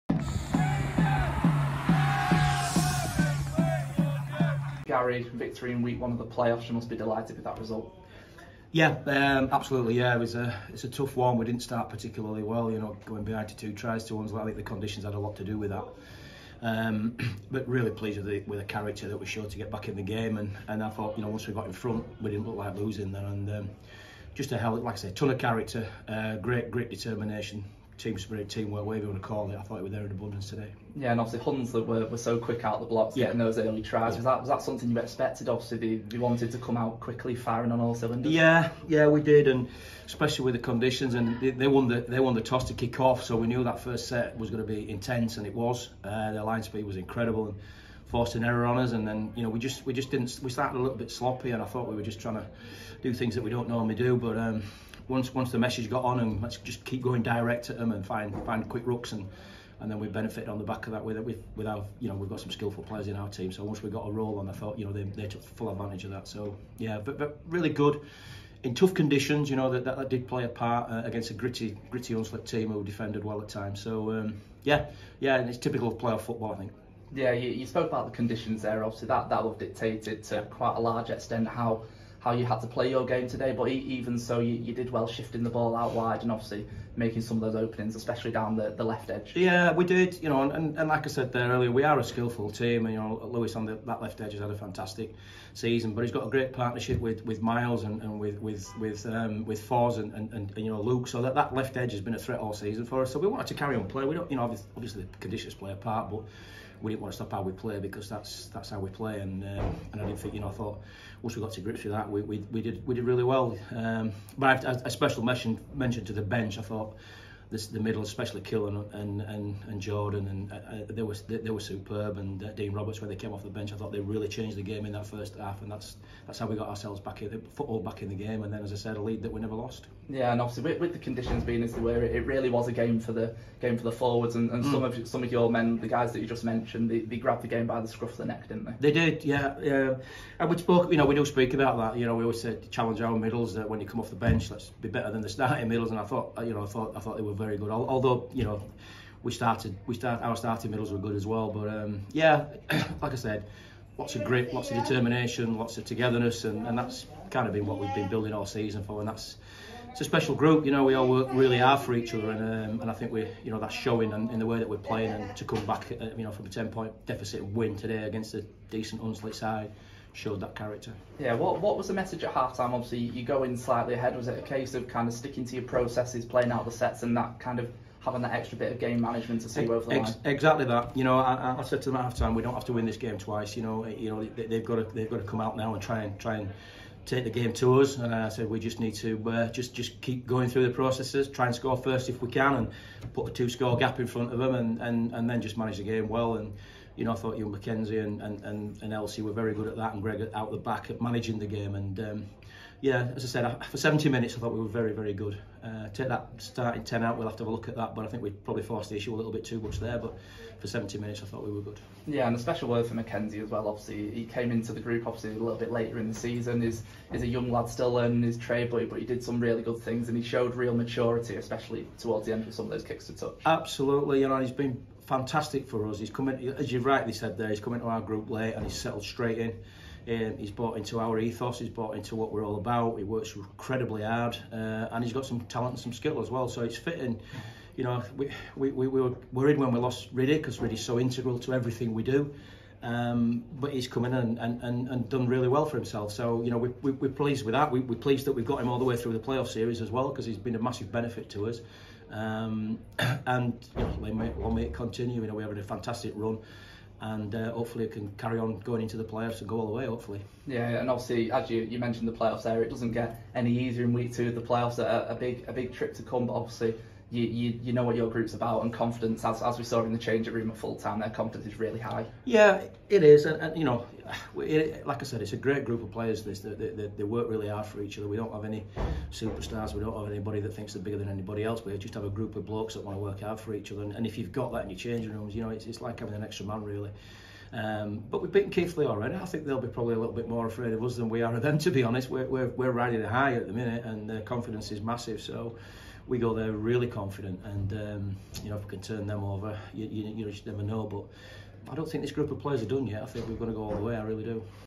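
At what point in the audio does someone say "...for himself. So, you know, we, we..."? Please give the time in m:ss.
4:05.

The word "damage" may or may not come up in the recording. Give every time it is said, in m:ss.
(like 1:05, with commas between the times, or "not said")
not said.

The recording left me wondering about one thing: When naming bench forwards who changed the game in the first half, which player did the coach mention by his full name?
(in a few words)
Dean Roberts.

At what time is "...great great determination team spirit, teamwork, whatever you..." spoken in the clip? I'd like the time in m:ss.
0:26.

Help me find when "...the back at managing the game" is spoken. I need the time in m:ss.
3:20.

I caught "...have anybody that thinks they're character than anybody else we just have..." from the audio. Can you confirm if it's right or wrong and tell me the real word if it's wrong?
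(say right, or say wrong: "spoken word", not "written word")
wrong: "bigger", not "character".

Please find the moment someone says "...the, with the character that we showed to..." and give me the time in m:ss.
0:18.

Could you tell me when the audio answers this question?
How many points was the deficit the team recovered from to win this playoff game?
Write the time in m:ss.
2:46.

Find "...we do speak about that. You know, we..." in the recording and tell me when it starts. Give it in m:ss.
2:21.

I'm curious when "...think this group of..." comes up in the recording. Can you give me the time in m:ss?
5:01.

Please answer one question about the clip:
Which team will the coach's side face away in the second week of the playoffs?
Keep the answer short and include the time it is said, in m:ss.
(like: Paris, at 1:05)
Keighley, at 4:48.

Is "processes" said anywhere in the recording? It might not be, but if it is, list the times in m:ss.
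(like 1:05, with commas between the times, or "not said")
2:55, 3:10.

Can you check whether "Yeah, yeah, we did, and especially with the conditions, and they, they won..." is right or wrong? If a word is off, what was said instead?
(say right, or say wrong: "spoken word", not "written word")
right.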